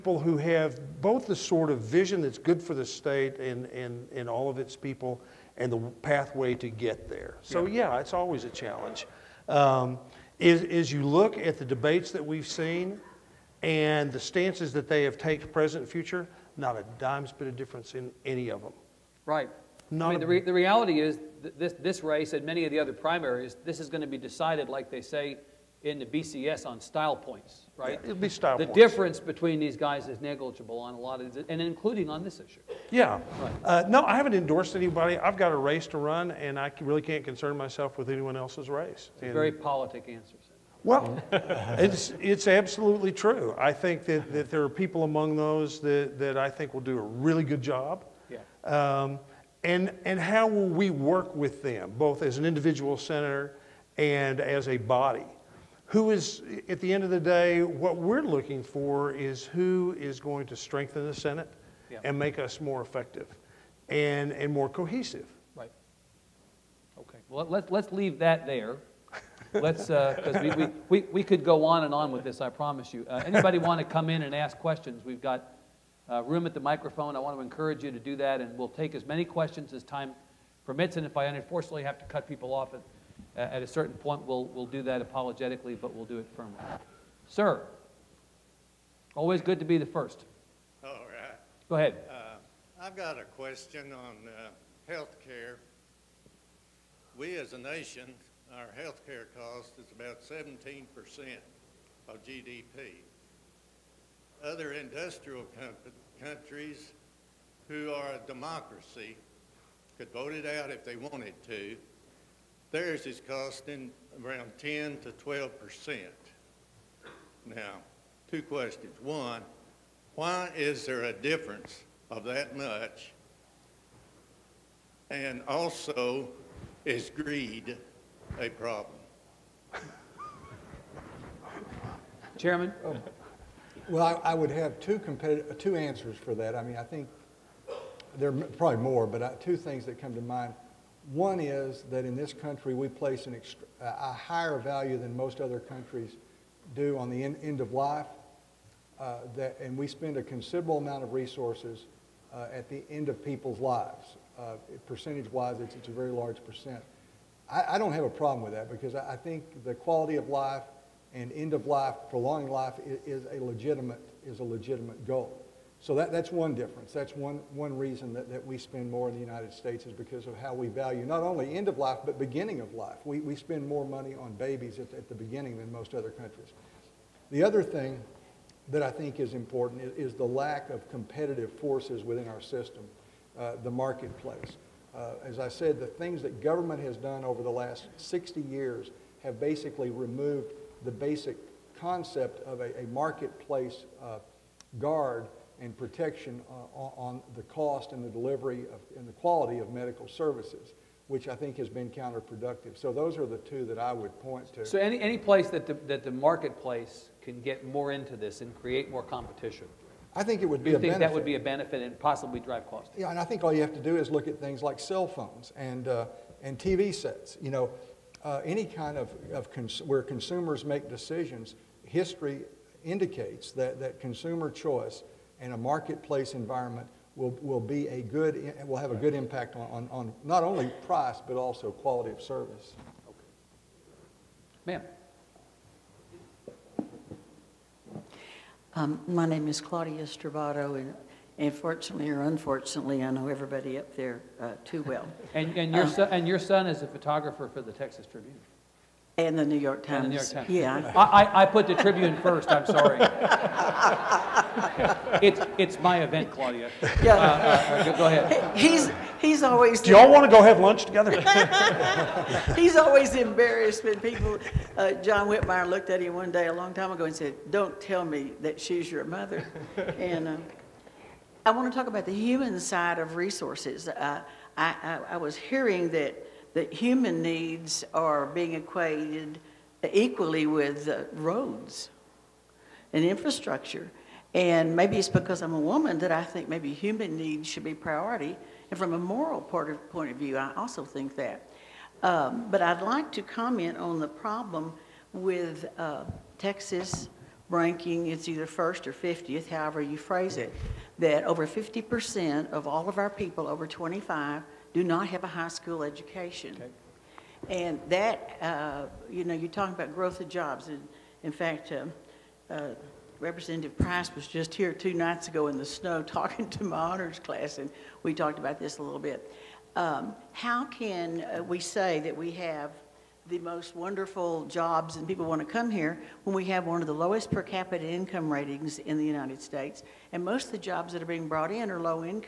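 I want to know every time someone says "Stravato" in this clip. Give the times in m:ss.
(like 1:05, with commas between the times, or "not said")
4:00.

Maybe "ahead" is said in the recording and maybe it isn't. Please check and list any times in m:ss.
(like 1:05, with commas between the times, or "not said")
1:31, 4:18.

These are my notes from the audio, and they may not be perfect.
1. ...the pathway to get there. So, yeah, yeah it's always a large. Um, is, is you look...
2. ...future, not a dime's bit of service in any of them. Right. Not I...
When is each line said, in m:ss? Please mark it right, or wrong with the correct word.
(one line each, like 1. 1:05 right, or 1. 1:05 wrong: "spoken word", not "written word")
1. 0:05 wrong: "challenge", not "large"
2. 0:15 wrong: "difference", not "service".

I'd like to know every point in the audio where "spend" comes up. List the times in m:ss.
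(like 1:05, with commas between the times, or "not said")
2:29, 2:48, 2:53.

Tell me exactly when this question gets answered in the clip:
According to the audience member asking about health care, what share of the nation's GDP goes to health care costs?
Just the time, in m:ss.
1:40.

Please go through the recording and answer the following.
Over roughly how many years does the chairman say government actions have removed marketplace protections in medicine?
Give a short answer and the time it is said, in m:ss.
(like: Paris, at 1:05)
60 years, at 3:07.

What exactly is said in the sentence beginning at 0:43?
I think that, that there are people among those that, that I think will do a really good job.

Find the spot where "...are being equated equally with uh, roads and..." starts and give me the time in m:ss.
4:37.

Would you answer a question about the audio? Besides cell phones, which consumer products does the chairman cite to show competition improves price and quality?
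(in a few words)
TV sets.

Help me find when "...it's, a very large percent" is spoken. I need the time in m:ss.
2:35.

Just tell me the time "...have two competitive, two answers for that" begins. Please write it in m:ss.
2:14.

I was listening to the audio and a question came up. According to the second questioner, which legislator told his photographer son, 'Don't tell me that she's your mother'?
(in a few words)
John Whitmire.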